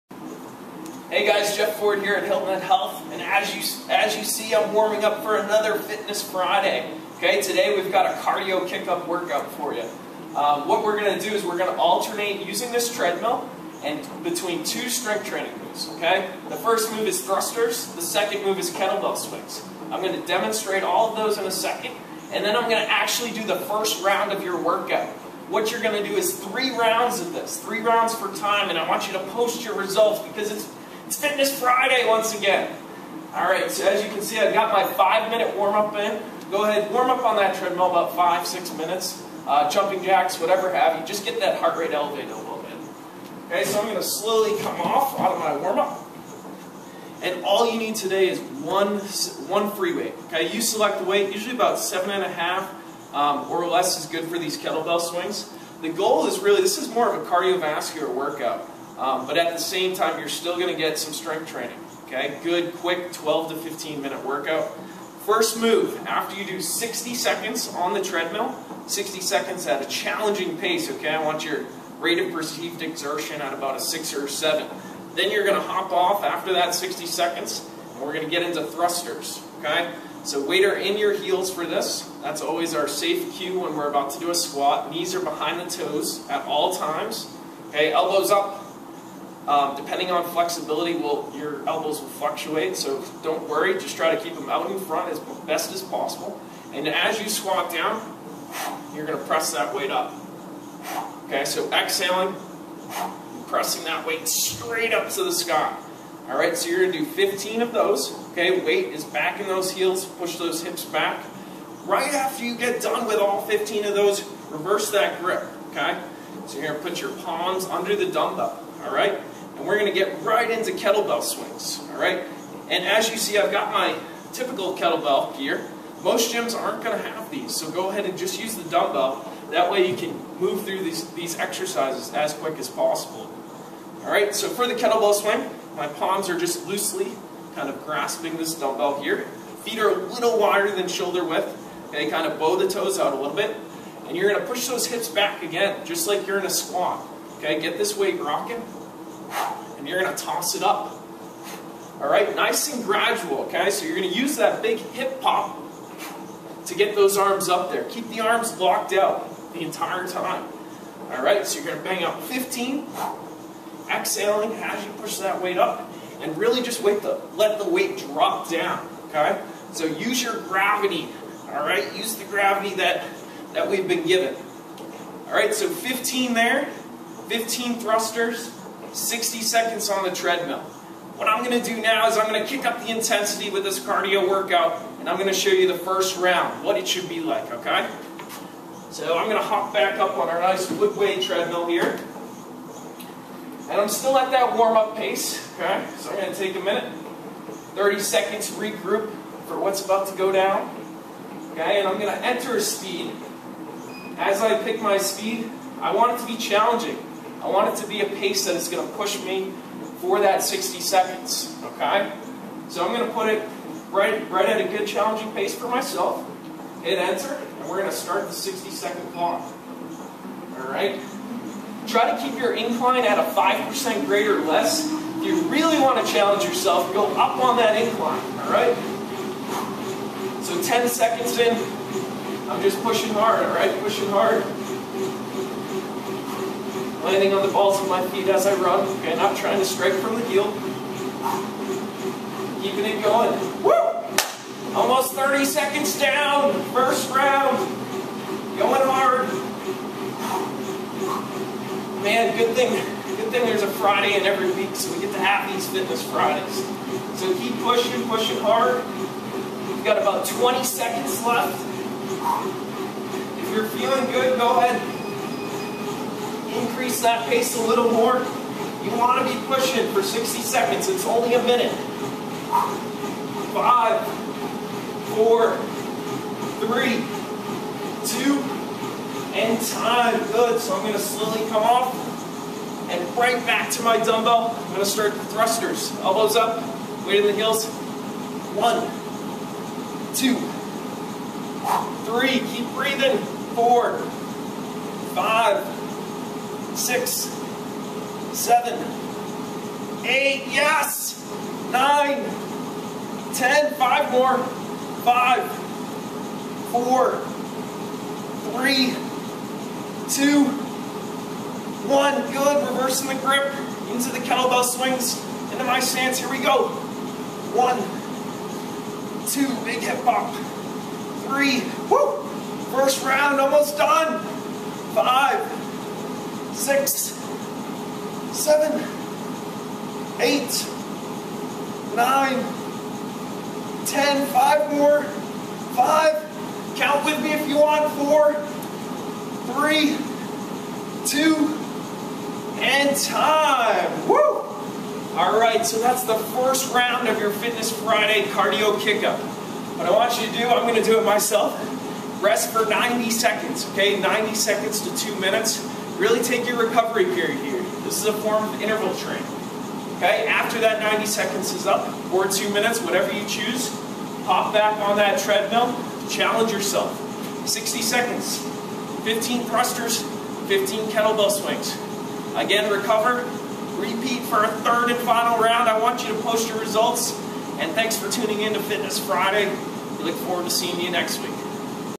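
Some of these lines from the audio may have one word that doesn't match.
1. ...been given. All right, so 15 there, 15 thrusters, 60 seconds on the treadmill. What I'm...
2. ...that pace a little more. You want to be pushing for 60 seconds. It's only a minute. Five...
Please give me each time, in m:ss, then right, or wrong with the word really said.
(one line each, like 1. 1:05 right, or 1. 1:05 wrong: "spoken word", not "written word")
1. 2:53 right
2. 4:27 right.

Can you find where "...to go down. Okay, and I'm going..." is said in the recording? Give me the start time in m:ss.
3:20.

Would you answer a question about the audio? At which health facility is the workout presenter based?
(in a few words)
Hilton Head Health.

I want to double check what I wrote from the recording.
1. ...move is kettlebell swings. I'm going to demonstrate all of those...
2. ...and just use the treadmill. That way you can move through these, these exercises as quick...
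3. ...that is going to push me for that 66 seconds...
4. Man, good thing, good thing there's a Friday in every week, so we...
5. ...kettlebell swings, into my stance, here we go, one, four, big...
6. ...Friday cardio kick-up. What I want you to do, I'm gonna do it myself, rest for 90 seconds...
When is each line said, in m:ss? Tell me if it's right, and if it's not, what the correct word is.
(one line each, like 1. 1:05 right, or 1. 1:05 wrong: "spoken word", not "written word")
1. 0:18 right
2. 2:08 wrong: "dumbbell", not "treadmill"
3. 3:28 wrong: "60", not "66"
4. 4:12 right
5. 5:14 wrong: "two", not "four"
6. 5:47 right.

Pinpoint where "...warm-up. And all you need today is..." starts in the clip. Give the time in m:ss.
0:45.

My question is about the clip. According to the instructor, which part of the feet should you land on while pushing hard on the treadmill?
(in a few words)
balls of my feet.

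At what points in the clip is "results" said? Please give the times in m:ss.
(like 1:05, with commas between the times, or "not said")
0:29, 6:16.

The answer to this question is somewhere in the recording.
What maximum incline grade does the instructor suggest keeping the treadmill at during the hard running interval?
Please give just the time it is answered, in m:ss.
3:43.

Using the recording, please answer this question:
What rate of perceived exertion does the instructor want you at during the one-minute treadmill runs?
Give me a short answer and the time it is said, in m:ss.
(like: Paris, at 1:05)
6 or 7, at 1:13.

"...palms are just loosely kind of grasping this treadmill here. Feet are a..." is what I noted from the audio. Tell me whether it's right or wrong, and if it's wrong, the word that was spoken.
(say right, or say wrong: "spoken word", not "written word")
wrong: "dumbbell", not "treadmill".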